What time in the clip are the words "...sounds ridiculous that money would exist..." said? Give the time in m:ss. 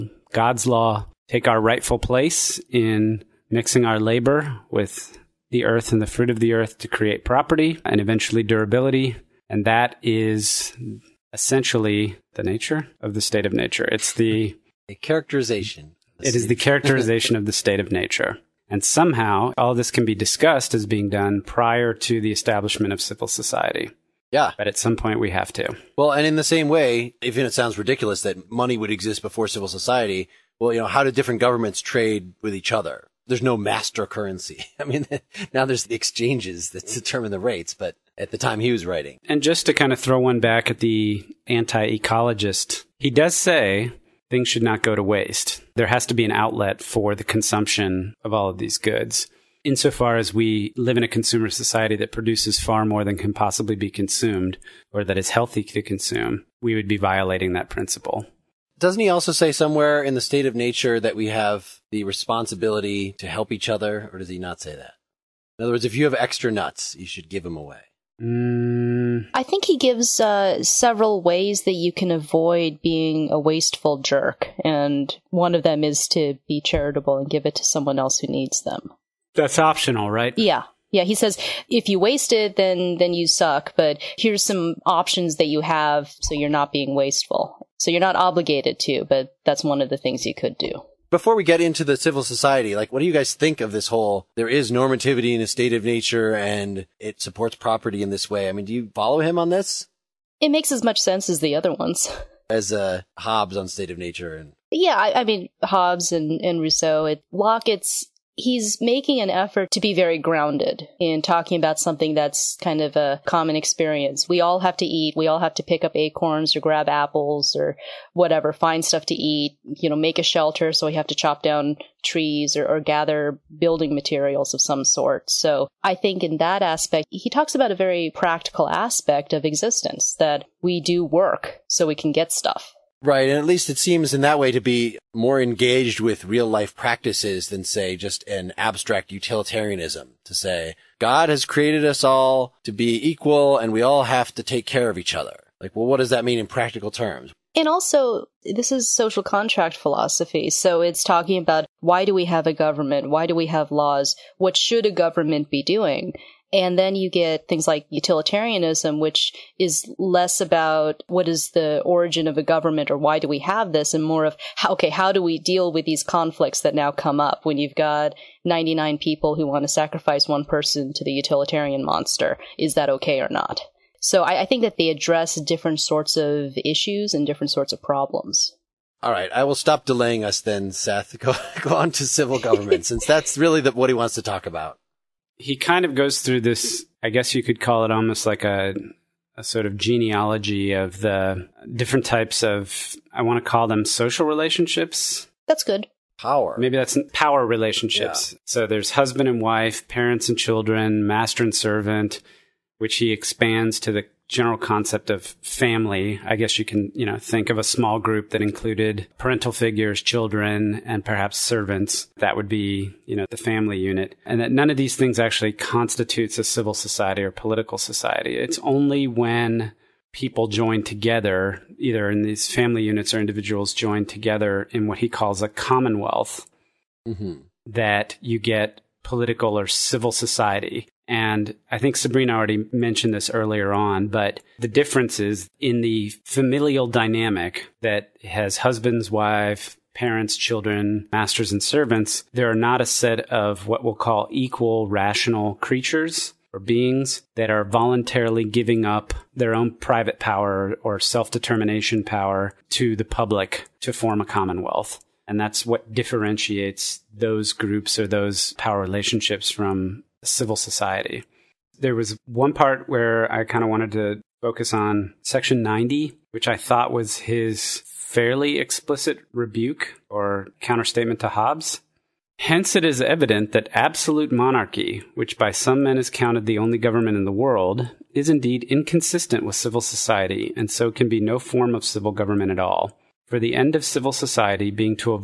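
0:27.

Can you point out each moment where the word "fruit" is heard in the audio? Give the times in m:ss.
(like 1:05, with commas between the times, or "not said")
0:06.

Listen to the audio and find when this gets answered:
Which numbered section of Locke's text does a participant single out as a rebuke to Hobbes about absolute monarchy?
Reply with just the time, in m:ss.
4:25.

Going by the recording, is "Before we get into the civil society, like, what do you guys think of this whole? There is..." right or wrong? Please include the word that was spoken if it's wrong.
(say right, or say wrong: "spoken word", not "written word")
right.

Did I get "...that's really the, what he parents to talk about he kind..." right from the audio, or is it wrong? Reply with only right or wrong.
wrong.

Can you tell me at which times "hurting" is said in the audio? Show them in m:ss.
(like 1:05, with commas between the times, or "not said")
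not said.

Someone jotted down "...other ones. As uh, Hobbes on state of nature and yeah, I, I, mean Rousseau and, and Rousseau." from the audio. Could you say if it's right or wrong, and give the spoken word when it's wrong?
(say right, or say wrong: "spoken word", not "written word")
wrong: "Hobbes", not "Rousseau".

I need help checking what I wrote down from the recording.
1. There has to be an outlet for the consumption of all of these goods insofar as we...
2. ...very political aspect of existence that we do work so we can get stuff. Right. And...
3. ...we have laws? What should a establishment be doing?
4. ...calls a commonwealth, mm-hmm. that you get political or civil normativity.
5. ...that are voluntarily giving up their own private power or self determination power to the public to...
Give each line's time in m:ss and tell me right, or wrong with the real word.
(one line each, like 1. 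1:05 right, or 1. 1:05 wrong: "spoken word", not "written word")
1. 0:45 right
2. 2:07 wrong: "practical", not "political"
3. 2:33 wrong: "government", not "establishment"
4. 3:45 wrong: "society", not "normativity"
5. 4:07 right.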